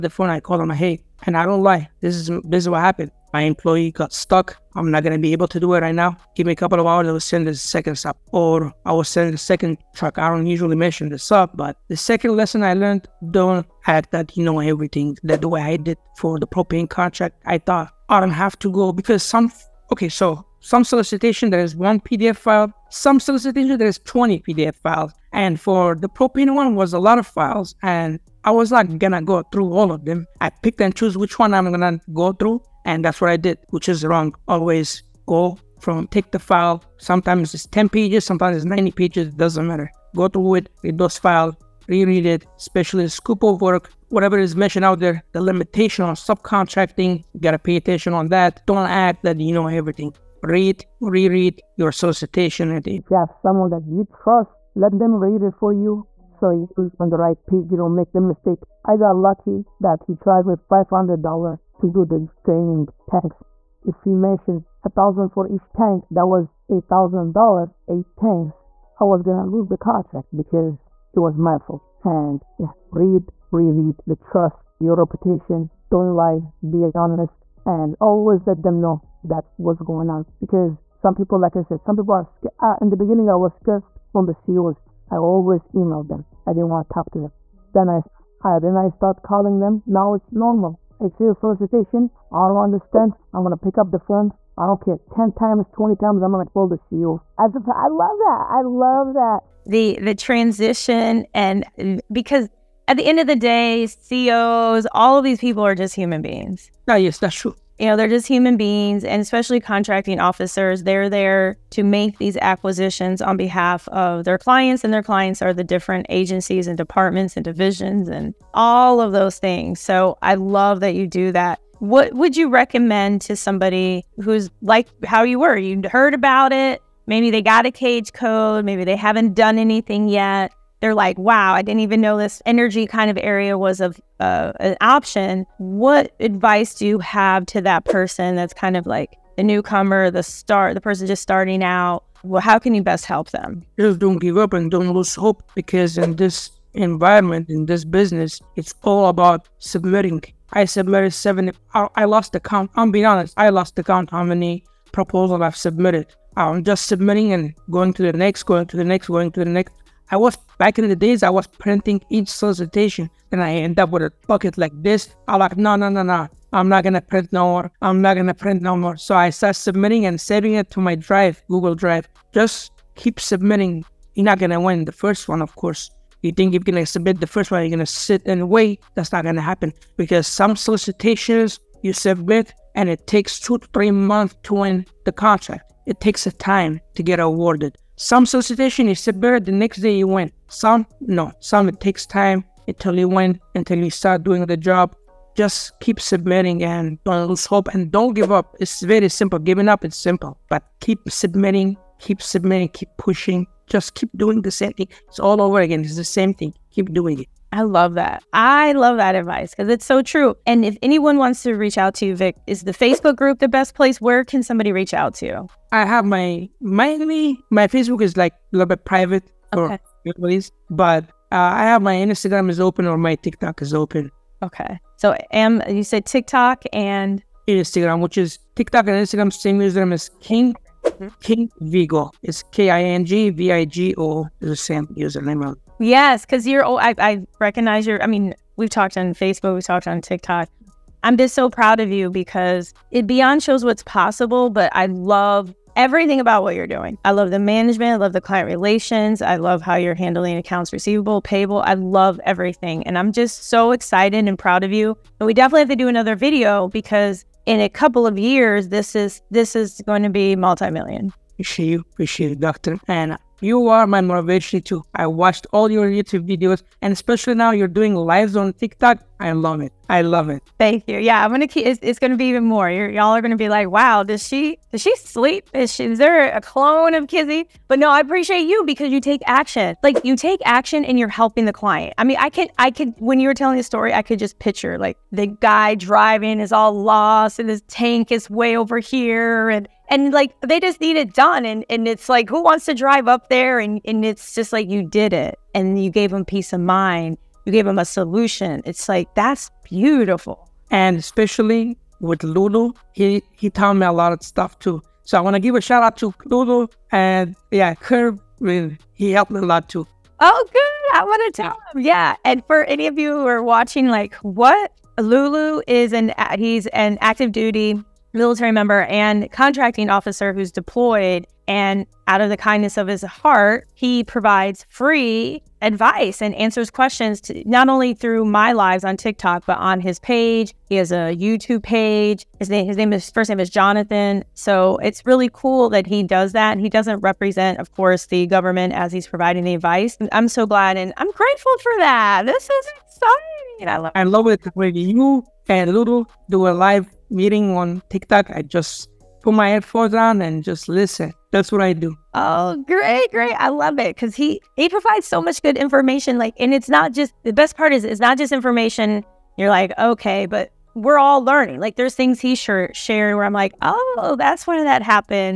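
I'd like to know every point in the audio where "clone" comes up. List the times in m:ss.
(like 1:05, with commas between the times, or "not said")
4:36.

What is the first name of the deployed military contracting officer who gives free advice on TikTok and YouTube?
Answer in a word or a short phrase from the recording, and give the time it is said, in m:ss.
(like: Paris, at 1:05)
Jonathan, at 5:33.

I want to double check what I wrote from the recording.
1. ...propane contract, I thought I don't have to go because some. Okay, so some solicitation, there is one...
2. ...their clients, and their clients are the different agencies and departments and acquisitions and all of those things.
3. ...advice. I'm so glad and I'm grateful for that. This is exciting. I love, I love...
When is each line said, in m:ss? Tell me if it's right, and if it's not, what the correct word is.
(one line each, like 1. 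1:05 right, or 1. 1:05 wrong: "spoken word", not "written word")
1. 0:16 right
2. 1:54 wrong: "divisions", not "acquisitions"
3. 5:39 right.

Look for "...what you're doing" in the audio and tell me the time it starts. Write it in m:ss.
4:06.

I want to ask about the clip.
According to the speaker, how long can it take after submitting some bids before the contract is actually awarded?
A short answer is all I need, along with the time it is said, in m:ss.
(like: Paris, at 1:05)
2 to 3 months, at 3:03.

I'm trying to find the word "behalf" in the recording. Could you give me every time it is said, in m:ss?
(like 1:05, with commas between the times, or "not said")
1:53.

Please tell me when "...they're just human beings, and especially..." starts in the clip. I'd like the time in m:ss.
1:47.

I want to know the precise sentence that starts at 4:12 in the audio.
And I'm just so excited and proud of you.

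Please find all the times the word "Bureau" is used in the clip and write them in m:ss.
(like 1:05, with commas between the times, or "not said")
not said.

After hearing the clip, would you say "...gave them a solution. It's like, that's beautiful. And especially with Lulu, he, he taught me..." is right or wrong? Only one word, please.
right.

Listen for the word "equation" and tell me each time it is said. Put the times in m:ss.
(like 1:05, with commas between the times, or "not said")
not said.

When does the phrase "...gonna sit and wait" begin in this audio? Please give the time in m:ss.
2:57.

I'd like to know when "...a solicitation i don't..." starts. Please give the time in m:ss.
1:31.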